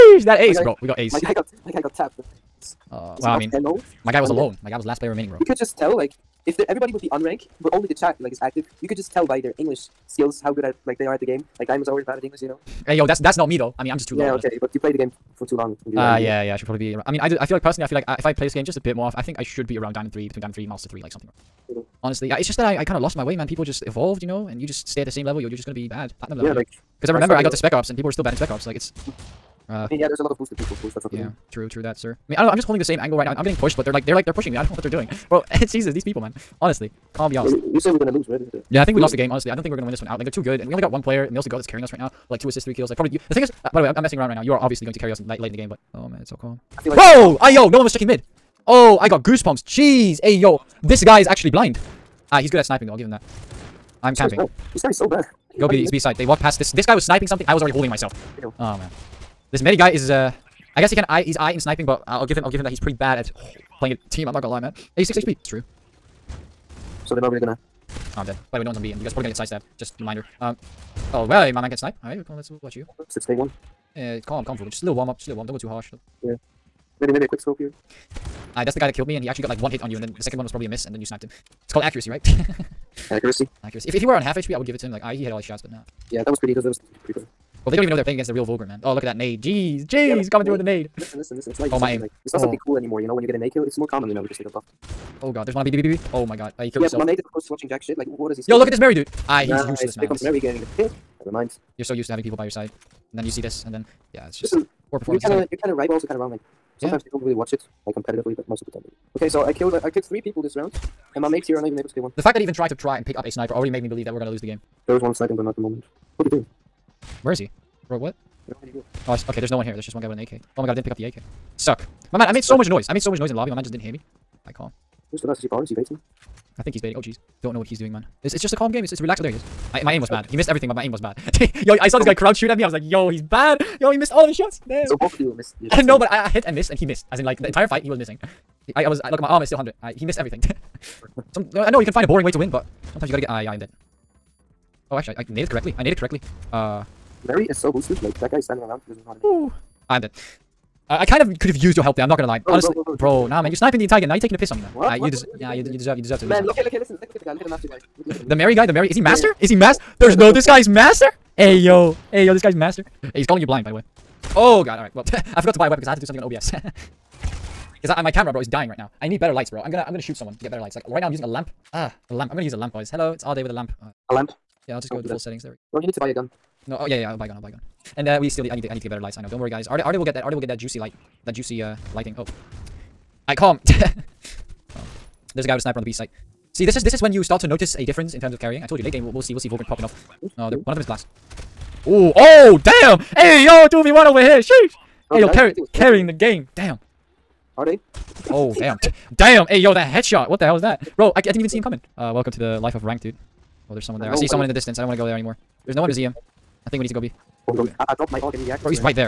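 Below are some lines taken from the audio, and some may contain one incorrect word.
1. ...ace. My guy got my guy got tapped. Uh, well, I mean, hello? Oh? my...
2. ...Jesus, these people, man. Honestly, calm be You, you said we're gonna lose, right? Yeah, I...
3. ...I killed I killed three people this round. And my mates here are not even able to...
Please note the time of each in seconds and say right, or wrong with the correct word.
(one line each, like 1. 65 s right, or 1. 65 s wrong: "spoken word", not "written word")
1. 0 s right
2. 35 s right
3. 109 s right.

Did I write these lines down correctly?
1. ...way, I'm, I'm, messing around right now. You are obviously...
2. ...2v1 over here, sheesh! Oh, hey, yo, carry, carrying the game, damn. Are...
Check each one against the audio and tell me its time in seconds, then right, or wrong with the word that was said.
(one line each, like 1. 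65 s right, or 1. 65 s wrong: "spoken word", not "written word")
1. 43 s right
2. 193 s right.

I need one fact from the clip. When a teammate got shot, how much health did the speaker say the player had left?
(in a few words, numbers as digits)
86 HP.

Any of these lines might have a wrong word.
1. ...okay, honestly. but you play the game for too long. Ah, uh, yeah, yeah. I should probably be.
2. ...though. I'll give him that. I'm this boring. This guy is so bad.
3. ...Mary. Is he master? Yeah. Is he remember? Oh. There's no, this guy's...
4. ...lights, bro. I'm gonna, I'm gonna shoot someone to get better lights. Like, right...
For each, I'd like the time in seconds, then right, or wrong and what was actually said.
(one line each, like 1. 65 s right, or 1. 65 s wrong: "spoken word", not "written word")
1. 14 s right
2. 52 s wrong: "camping", not "boring"
3. 158 s wrong: "master", not "remember"
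4. 169 s right.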